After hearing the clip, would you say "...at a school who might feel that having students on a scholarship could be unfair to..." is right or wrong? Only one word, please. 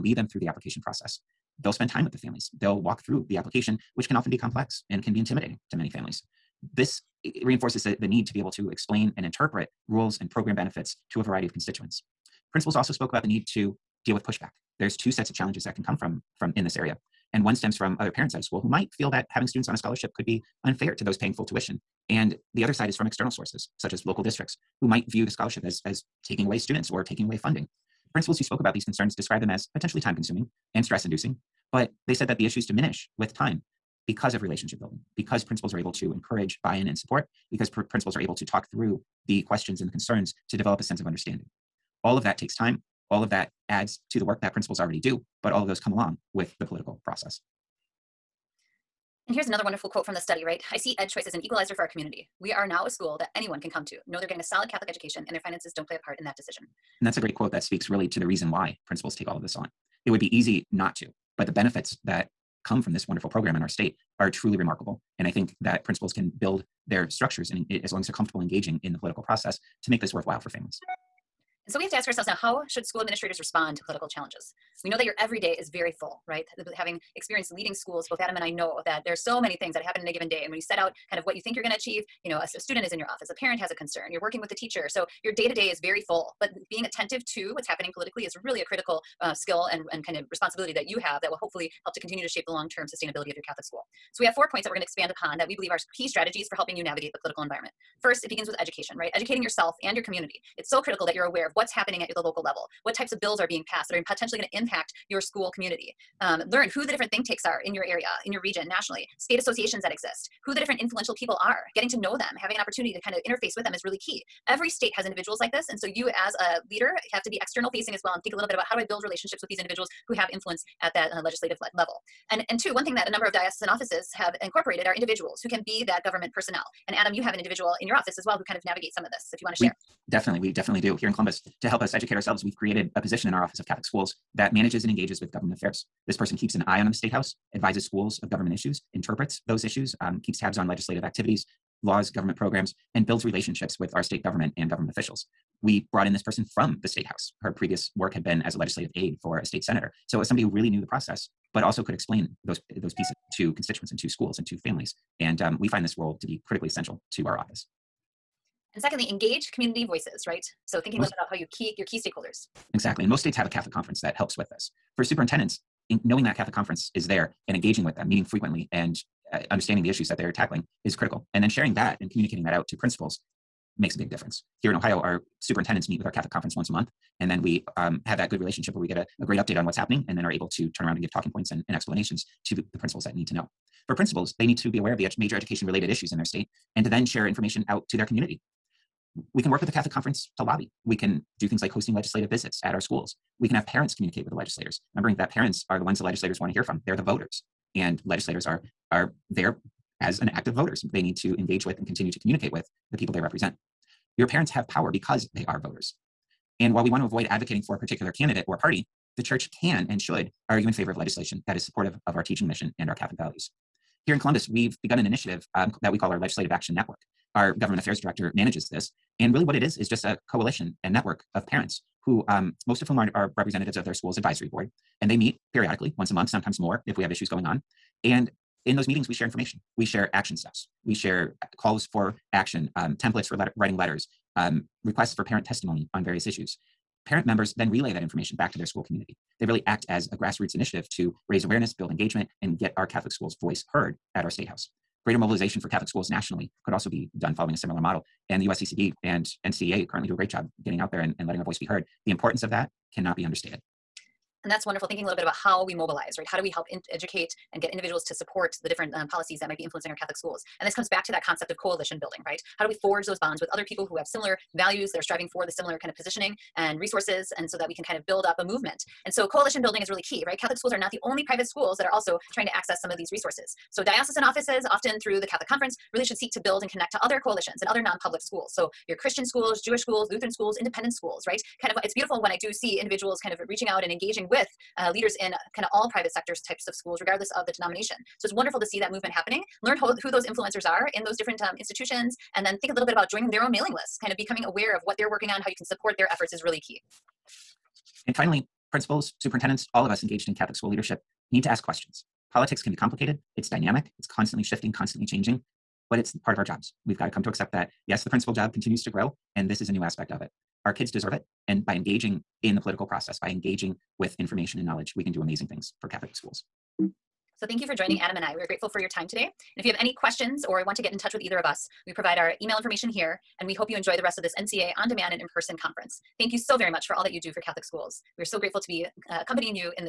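right.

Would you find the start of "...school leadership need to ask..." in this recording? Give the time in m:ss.
5:00.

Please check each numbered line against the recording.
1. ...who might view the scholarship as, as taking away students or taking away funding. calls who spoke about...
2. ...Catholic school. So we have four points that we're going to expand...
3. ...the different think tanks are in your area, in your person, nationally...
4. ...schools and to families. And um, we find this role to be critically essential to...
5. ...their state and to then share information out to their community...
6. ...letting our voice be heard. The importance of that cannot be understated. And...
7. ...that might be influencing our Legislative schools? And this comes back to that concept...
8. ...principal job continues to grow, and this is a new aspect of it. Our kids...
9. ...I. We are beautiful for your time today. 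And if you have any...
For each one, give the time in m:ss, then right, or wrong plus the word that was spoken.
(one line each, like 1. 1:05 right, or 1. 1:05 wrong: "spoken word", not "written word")
1. 0:24 wrong: "principals", not "calls"
2. 1:33 right
3. 1:46 wrong: "region", not "person"
4. 2:34 right
5. 3:06 right
6. 4:11 right
7. 4:19 wrong: "Catholic", not "Legislative"
8. 5:08 right
9. 5:18 wrong: "grateful", not "beautiful".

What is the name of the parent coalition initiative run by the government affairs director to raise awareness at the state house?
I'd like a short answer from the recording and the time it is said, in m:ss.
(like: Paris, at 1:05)
Legislative Action Network, at 3:36.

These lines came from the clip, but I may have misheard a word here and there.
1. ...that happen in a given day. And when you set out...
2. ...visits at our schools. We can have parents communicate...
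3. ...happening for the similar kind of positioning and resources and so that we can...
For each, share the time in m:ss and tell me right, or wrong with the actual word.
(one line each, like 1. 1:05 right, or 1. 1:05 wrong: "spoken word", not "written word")
1. 1:19 right
2. 3:12 right
3. 4:25 wrong: "striving", not "happening".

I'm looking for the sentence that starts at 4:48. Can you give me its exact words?
So it's wonderful to see that movement happening.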